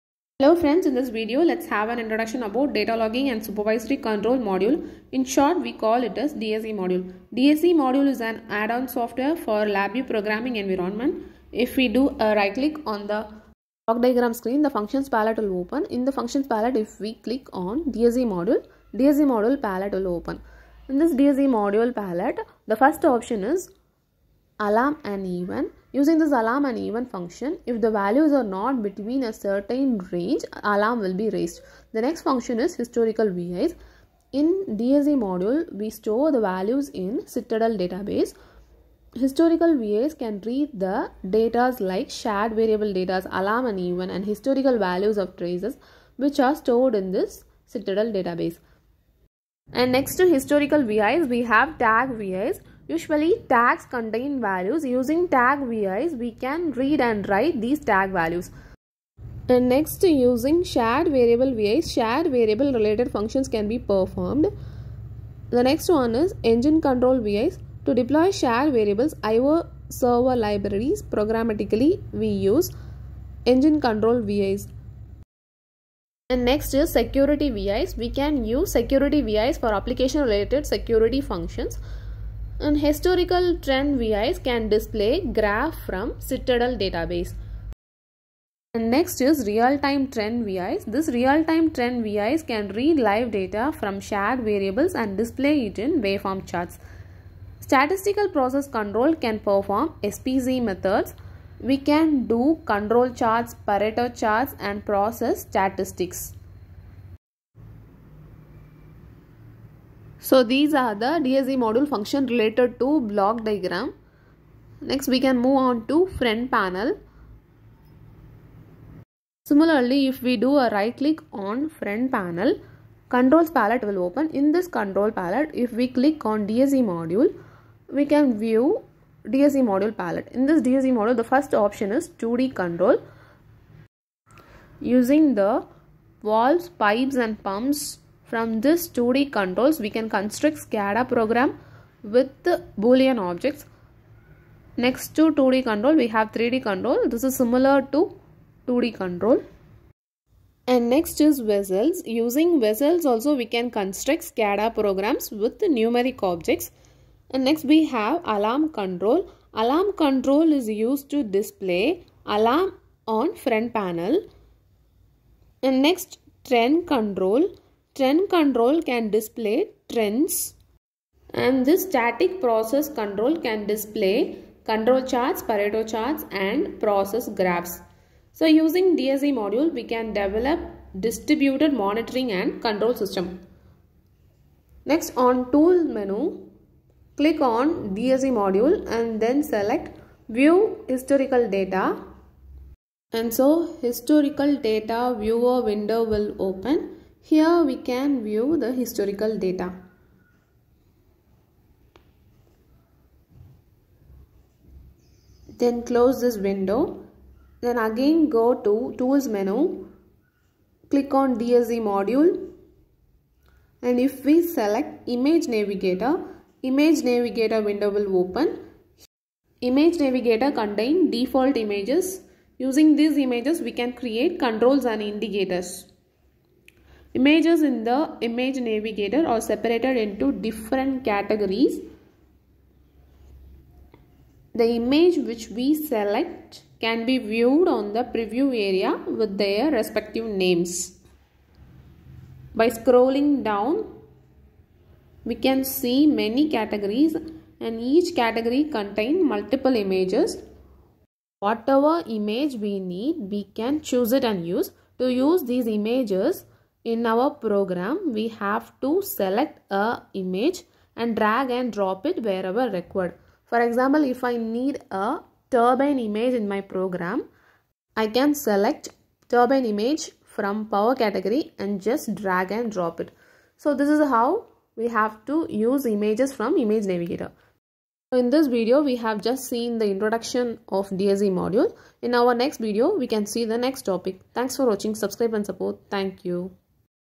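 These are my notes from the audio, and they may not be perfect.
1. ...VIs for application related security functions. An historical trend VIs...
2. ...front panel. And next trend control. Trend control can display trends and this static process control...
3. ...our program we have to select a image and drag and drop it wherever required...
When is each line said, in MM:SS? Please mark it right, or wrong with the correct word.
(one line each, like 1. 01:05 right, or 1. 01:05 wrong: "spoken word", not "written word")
1. 01:19 right
2. 02:43 right
3. 04:17 right.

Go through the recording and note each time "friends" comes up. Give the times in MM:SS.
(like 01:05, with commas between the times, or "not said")
00:00.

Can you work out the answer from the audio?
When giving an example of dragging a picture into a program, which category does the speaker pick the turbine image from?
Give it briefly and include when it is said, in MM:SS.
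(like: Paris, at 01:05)
Power, at 04:30.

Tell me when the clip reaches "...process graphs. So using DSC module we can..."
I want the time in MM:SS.
02:56.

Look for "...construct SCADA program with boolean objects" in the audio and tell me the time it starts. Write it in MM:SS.
02:20.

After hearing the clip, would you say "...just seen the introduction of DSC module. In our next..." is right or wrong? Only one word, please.
right.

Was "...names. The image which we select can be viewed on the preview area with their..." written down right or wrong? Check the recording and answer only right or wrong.
wrong.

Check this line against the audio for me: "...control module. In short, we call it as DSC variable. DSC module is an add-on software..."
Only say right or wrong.
wrong.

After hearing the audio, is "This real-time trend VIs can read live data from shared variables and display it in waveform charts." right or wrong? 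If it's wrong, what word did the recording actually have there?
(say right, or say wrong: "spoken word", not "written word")
right.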